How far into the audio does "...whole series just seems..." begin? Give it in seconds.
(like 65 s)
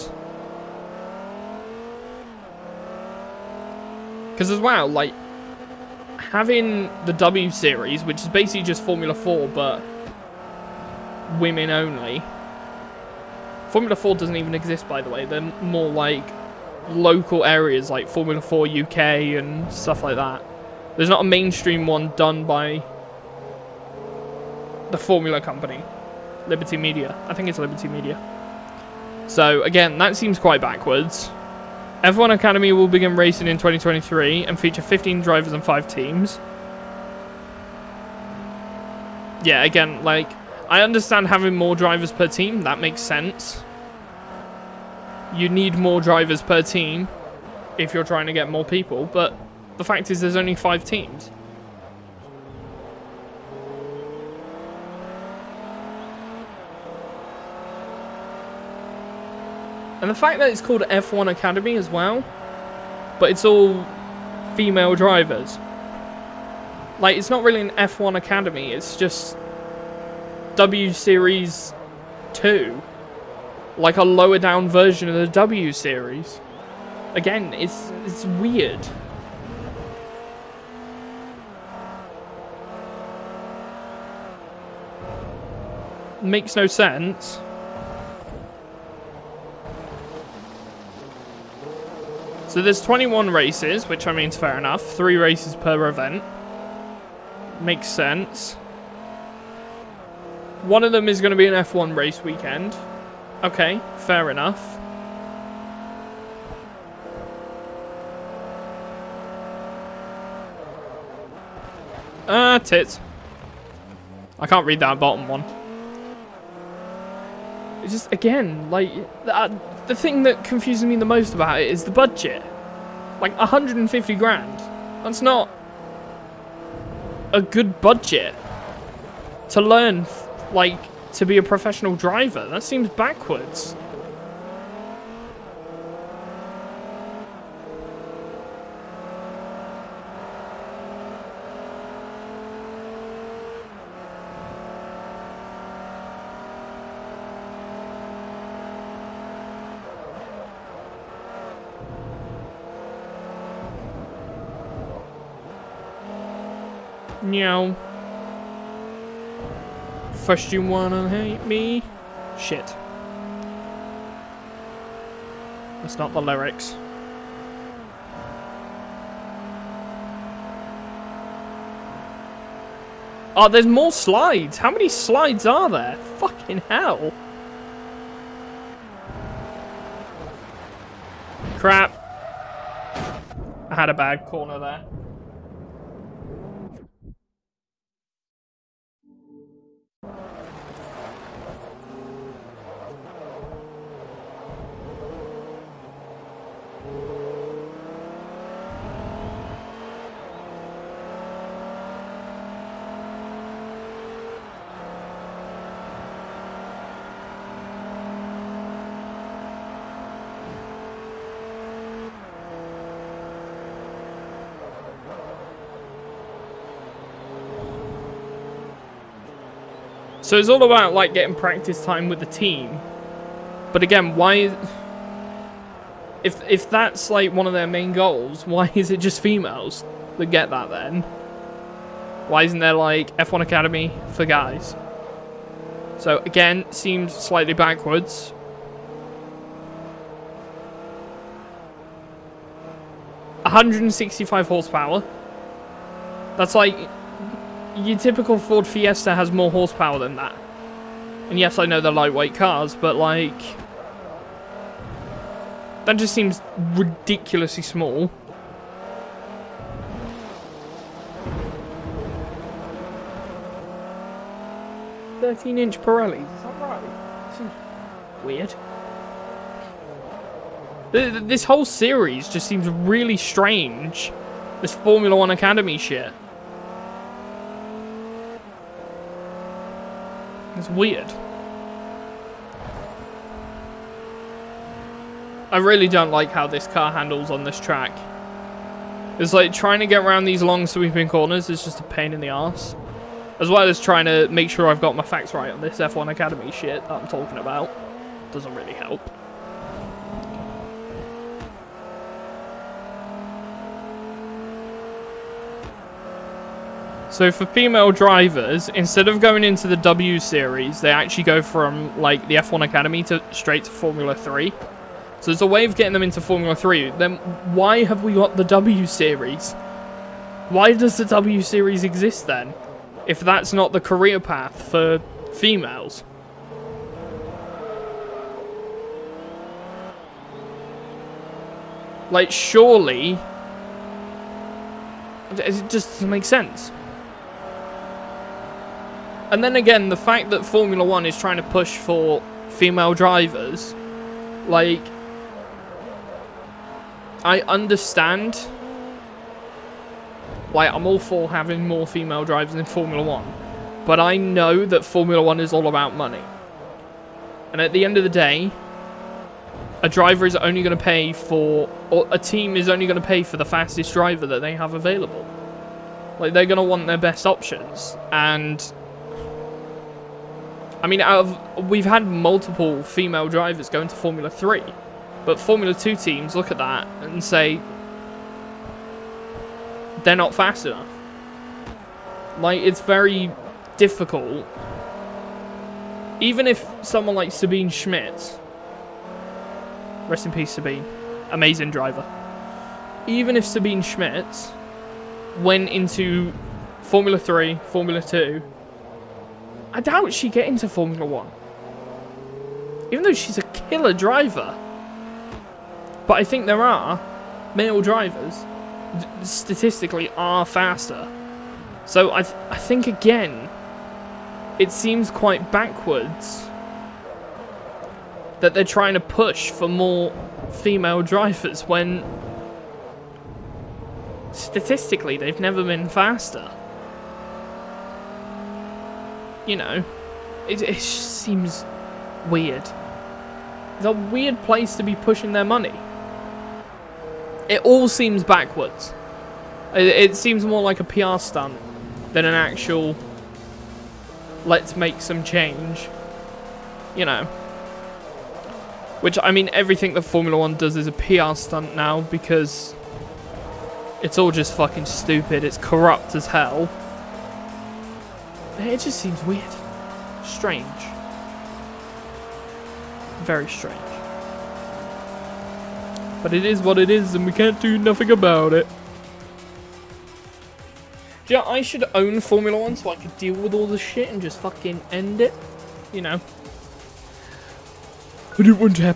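271 s.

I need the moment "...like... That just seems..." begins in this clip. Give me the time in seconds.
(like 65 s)
252 s.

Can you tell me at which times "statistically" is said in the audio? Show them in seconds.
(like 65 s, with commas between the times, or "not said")
409 s, 424 s.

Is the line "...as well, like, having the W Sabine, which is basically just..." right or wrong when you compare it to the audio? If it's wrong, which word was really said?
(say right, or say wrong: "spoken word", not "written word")
wrong: "Series", not "Sabine".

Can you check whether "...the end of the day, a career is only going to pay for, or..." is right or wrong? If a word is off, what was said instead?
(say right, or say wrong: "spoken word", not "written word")
wrong: "driver", not "career".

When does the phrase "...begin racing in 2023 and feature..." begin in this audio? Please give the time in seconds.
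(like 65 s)
32 s.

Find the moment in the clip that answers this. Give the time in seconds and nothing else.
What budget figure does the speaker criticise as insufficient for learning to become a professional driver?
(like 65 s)
123 s.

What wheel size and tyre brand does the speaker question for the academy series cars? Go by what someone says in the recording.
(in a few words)
13-inch Pirellis.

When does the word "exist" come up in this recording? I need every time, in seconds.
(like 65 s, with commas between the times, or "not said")
14 s, 321 s.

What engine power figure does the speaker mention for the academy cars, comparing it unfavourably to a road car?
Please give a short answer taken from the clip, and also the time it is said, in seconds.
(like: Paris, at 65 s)
165 horsepower, at 243 s.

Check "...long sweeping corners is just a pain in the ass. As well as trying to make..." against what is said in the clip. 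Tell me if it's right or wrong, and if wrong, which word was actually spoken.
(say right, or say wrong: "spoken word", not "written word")
right.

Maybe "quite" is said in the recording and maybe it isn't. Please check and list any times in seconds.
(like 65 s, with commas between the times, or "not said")
30 s, 415 s.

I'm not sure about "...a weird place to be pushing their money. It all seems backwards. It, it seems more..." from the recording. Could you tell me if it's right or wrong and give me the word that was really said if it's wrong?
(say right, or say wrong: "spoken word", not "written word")
right.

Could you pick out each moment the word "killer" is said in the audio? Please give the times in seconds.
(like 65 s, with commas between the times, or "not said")
403 s.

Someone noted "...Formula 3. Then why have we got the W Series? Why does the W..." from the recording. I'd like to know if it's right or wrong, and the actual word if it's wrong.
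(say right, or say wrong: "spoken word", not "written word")
right.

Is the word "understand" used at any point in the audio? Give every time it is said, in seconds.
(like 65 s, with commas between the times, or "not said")
40 s, 347 s.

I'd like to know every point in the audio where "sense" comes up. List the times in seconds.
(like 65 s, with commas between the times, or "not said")
42 s, 86 s, 97 s, 336 s.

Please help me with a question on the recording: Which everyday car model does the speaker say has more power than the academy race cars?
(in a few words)
Ford Fiesta.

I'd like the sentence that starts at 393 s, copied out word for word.
Even if Sabine Schmitz went into Formula 3, Formula 2, I doubt she'd get into Formula One.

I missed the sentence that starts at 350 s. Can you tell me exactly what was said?
Like, I'm all for having more female drivers in Formula One.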